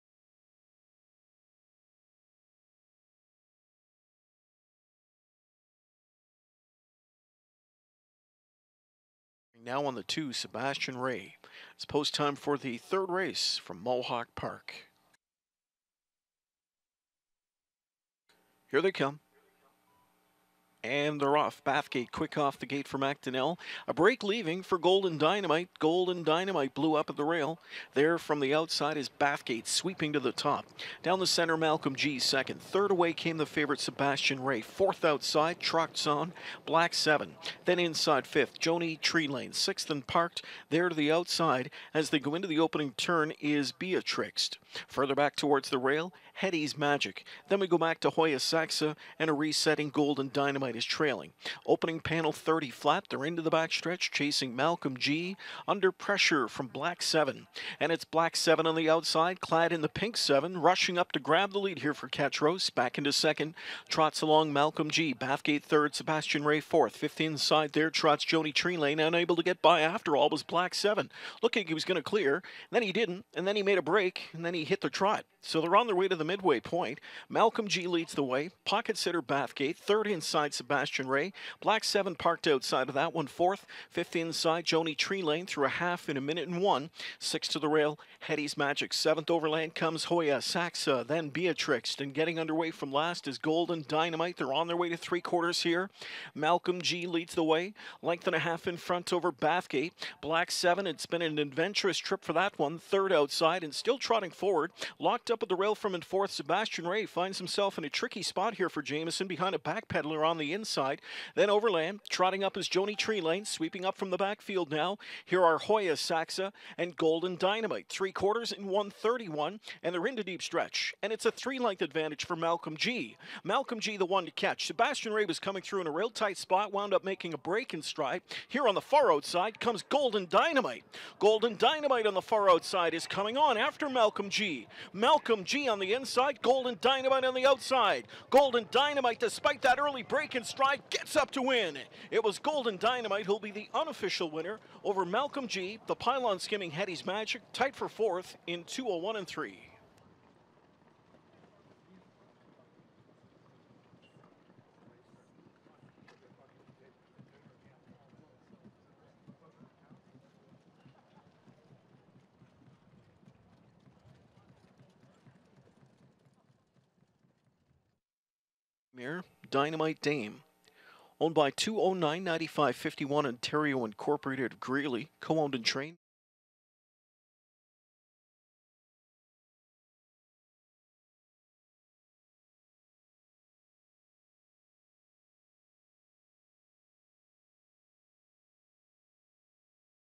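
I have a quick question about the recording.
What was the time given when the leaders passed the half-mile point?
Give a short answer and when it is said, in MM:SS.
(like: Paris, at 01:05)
1:01, at 01:26.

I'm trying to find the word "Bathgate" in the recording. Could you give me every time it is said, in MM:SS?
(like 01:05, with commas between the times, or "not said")
00:21, 00:29, 01:05, 01:19, 01:39.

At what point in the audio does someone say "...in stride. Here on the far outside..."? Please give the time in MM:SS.
02:07.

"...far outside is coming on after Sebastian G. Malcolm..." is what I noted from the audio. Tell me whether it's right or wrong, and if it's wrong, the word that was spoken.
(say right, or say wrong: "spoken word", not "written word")
wrong: "Malcolm", not "Sebastian".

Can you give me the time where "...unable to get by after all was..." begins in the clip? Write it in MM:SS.
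01:09.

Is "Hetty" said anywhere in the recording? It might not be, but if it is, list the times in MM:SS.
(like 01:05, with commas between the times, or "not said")
00:46, 01:28, 02:26.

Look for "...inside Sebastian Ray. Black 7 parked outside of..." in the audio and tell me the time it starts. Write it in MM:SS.
01:20.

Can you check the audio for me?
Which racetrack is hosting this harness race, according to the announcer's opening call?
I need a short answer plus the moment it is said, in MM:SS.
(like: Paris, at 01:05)
Mohawk Park, at 00:13.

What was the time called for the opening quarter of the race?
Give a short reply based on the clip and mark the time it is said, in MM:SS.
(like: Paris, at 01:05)
30 flat, at 00:52.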